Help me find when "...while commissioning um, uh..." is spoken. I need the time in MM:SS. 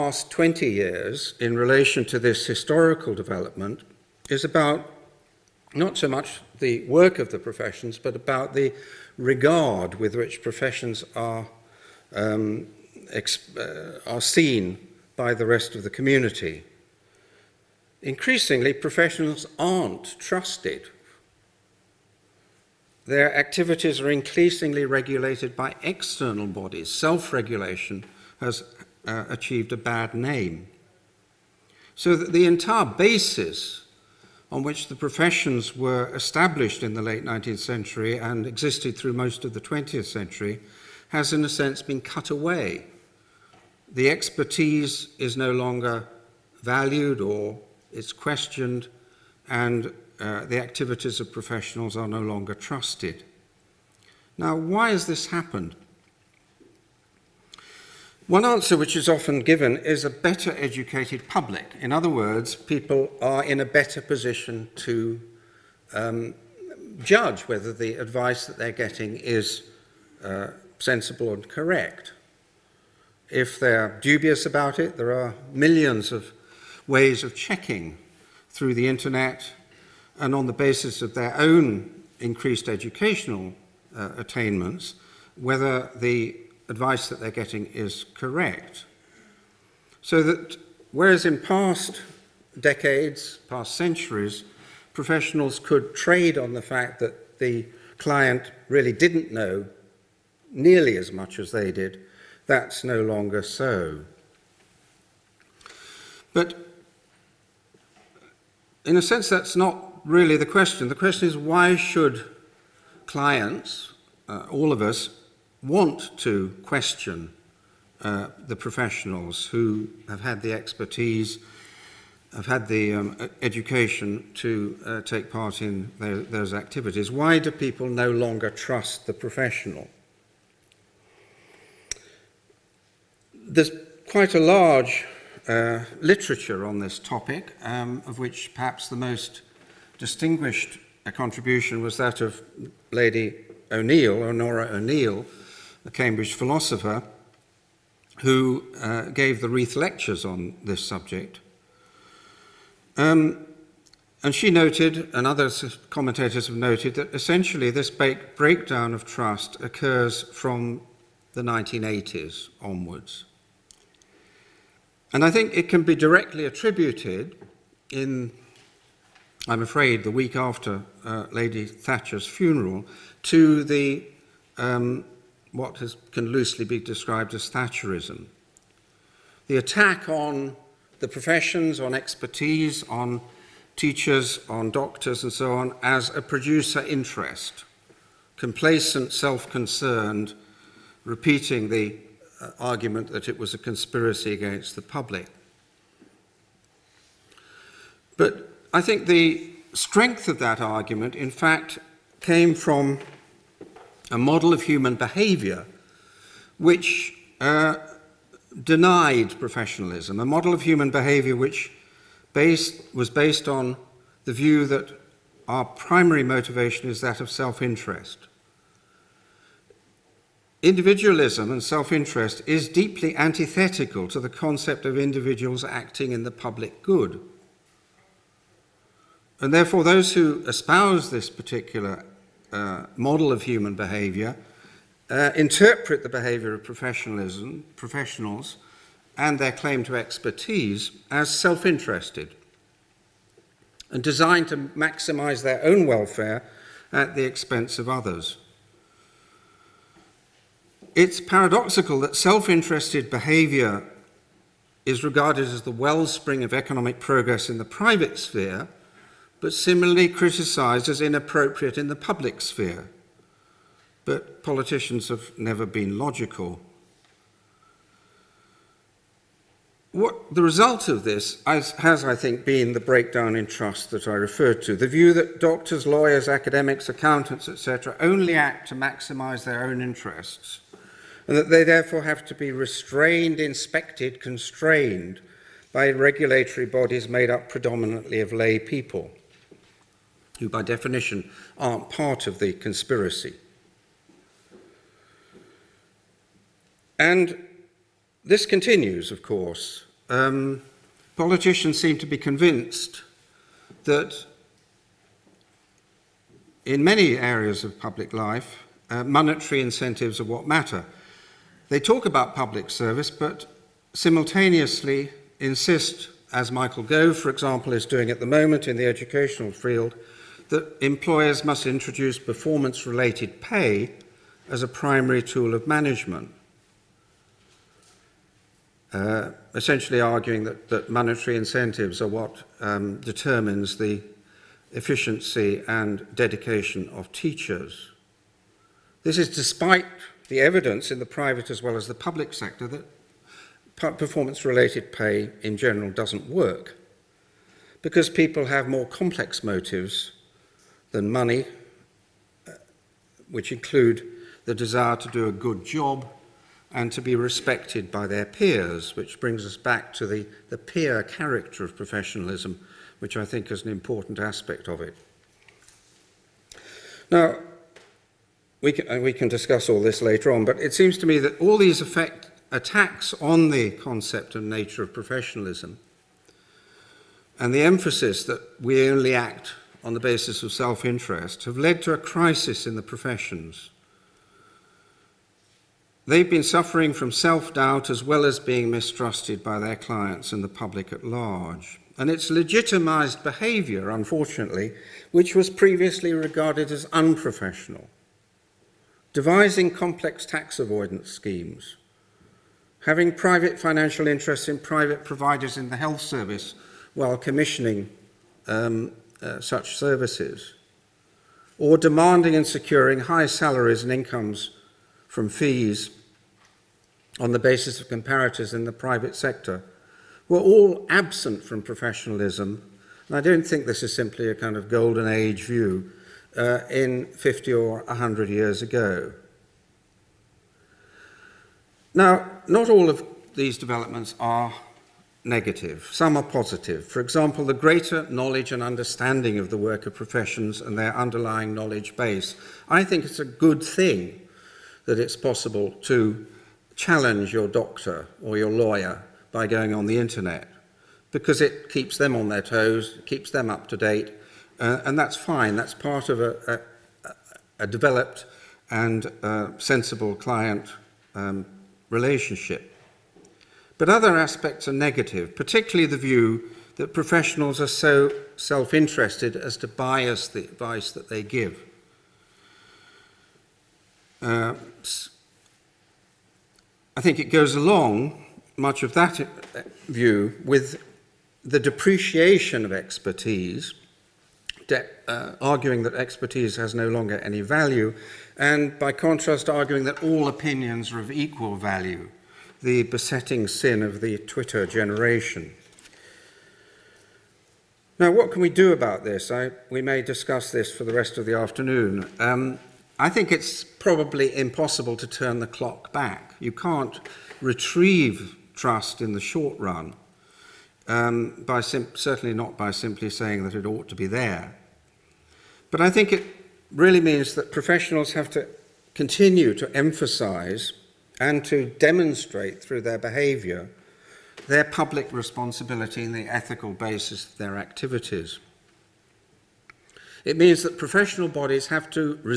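06:46.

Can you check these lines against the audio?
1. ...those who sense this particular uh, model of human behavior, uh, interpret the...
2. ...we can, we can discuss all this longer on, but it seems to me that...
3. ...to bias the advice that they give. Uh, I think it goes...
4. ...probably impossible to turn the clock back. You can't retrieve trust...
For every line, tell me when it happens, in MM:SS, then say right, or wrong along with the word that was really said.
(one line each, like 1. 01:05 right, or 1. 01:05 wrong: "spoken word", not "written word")
1. 03:49 wrong: "espouse", not "sense"
2. 06:08 wrong: "later", not "longer"
3. 07:49 right
4. 08:23 right.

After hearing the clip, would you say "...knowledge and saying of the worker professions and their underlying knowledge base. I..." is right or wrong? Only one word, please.
wrong.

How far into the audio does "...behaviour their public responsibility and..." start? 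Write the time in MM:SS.
08:42.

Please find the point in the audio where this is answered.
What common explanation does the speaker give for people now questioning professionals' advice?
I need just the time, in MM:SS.
01:00.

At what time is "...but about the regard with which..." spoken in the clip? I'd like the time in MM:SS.
00:07.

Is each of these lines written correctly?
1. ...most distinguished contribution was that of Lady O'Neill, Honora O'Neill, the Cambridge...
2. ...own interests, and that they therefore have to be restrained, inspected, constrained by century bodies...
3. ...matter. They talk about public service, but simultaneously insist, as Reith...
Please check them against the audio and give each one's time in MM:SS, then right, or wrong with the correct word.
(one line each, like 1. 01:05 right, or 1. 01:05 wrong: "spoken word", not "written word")
1. 02:18 right
2. 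04:39 wrong: "regulatory", not "century"
3. 05:10 wrong: "Michael", not "Reith".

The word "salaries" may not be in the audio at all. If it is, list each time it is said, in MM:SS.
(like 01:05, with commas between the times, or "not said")
06:53.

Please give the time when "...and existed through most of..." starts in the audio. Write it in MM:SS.
00:38.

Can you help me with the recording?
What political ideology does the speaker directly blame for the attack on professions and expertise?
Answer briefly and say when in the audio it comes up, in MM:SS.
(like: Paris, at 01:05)
Thatcherism, at 02:57.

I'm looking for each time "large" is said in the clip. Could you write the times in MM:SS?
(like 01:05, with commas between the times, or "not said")
02:14, 06:31.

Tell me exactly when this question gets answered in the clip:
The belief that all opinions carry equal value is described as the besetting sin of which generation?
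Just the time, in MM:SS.
08:14.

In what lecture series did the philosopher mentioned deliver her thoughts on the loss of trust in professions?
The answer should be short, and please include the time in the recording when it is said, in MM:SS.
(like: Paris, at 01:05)
The Reith lectures, at 02:29.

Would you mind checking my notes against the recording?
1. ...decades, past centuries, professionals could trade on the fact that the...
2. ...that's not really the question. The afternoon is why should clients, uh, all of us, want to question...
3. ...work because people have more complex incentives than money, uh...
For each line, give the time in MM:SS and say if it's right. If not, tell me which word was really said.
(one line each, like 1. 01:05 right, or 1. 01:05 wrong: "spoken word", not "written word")
1. 01:32 right
2. 01:49 wrong: "question", not "afternoon"
3. 05:46 wrong: "motives", not "incentives".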